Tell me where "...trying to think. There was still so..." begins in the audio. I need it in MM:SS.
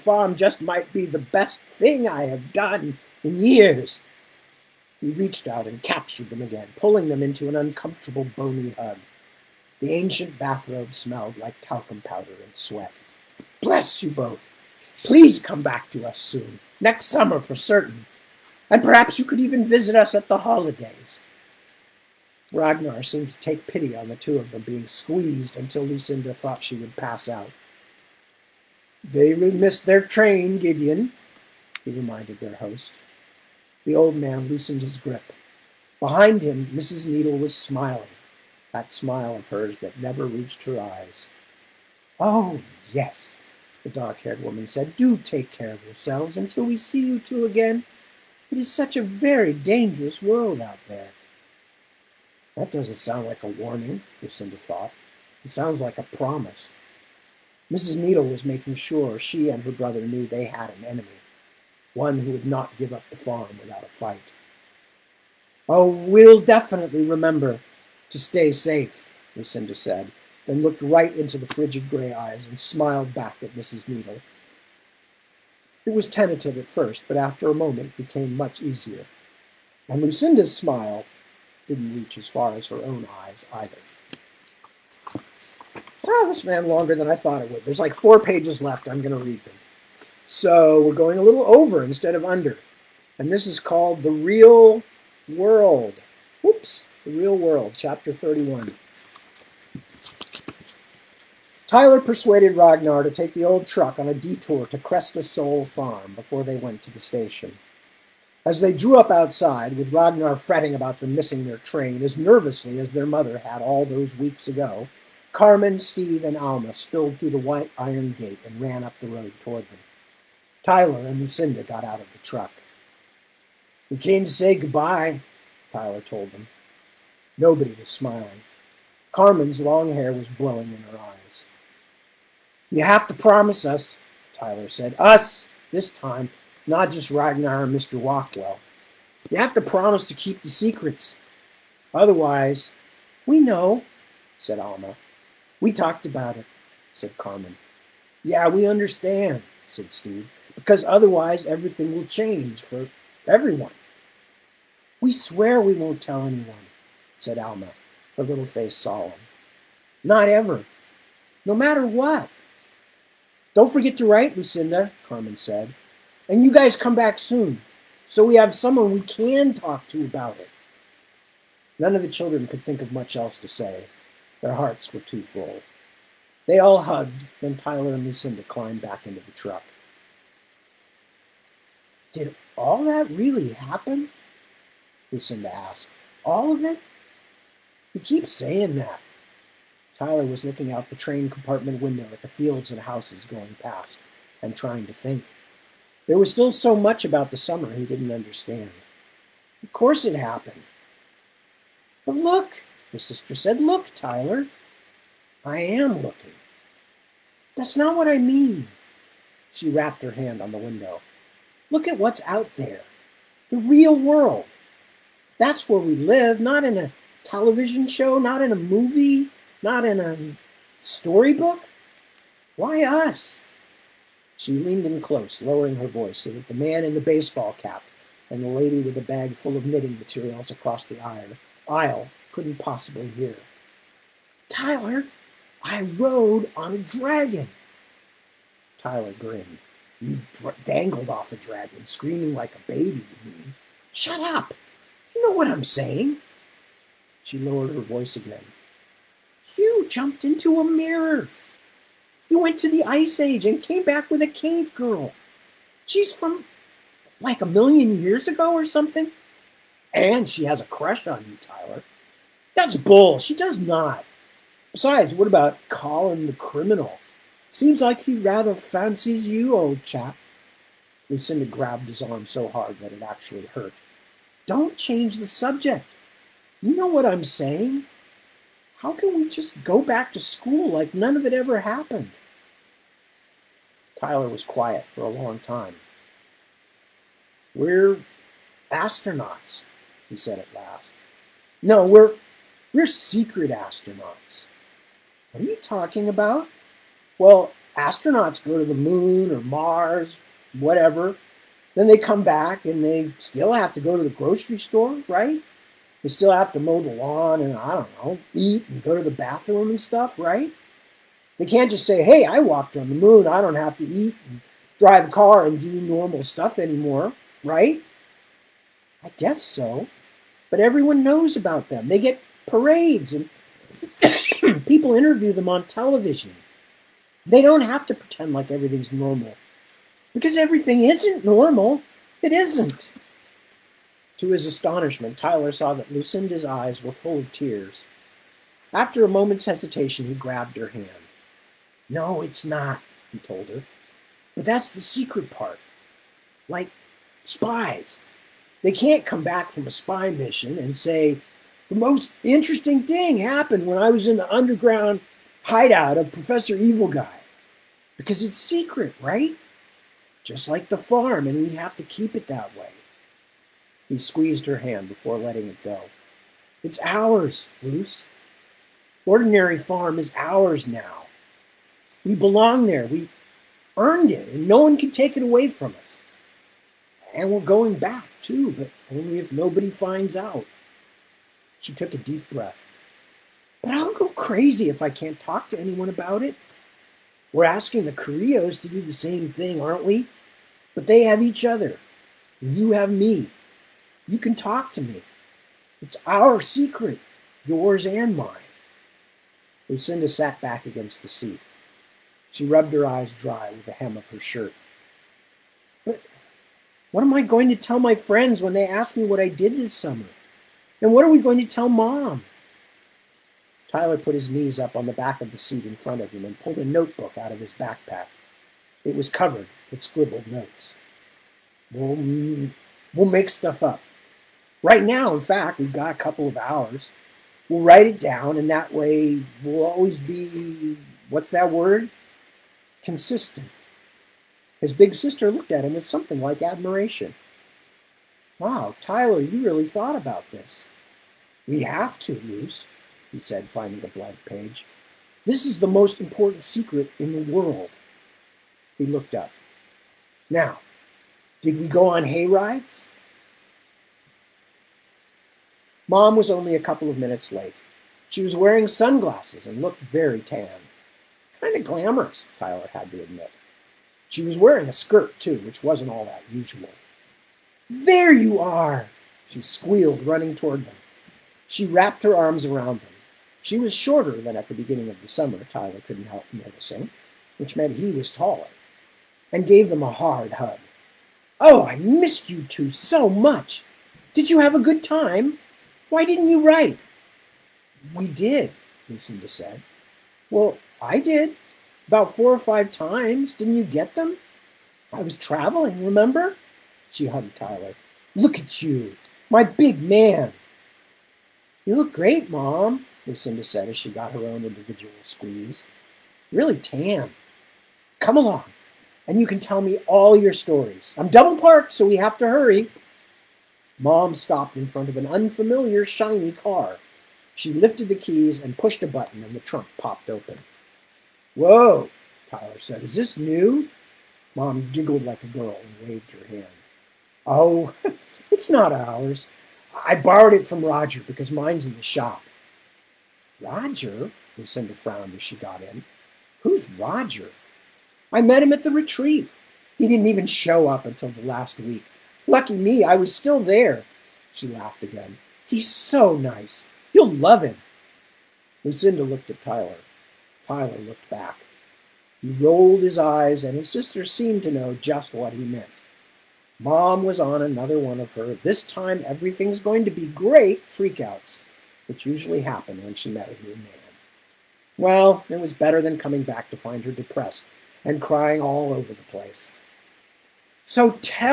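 03:14.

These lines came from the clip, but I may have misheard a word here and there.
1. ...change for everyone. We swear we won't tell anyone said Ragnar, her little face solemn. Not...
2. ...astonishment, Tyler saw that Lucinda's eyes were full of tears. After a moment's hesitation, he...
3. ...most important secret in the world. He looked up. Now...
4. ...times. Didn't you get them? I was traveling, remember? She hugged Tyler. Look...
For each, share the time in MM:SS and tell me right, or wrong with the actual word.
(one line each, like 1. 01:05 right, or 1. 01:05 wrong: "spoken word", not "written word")
1. 02:32 wrong: "Alma", not "Ragnar"
2. 05:34 right
3. 07:25 right
4. 08:12 right.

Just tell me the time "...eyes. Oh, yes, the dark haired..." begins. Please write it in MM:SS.
00:40.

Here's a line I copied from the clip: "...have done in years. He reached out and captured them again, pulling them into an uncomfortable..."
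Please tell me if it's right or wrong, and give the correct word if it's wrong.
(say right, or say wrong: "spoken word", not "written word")
right.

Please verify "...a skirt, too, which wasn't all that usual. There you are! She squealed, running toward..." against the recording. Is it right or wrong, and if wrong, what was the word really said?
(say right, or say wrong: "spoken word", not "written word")
right.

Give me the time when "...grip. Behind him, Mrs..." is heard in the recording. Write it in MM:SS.
00:34.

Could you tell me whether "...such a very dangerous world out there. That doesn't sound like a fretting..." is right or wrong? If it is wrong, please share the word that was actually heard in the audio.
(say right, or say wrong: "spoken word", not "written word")
wrong: "warning", not "fretting".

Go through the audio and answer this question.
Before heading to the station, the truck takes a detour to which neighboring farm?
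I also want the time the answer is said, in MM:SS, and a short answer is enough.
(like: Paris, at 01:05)
Cresta Soul Farm, at 01:44.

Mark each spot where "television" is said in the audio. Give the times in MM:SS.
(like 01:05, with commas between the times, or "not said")
03:37, 05:25.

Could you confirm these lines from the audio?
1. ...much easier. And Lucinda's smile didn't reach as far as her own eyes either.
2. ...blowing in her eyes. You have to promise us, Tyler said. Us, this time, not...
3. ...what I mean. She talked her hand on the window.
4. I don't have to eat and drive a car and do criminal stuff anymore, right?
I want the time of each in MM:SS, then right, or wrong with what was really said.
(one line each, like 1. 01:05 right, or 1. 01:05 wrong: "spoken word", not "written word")
1. 01:18 right
2. 02:10 right
3. 03:27 wrong: "rapped", not "talked"
4. 05:13 wrong: "normal", not "criminal".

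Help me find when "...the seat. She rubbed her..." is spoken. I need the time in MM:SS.
06:41.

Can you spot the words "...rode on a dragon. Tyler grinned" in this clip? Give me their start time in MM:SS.
03:55.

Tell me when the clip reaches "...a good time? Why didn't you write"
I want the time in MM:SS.
08:04.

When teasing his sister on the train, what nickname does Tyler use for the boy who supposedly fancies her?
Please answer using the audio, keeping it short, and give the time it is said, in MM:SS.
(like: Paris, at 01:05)
Colin the criminal, at 04:25.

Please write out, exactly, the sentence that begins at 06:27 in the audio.
We're asking the Correas to do the same thing, aren't we?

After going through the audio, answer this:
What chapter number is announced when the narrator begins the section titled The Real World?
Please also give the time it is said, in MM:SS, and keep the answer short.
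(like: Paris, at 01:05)
31, at 01:37.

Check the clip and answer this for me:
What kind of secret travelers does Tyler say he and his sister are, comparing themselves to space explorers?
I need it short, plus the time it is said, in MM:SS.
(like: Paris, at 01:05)
secret astronauts, at 04:52.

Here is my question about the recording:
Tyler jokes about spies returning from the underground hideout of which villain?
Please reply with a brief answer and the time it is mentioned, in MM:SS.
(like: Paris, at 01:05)
Professor Evil Guy, at 05:56.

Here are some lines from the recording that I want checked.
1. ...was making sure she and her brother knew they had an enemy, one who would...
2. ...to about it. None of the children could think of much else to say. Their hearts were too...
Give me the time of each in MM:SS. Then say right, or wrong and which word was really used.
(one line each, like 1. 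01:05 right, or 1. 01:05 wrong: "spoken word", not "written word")
1. 00:58 right
2. 02:49 right.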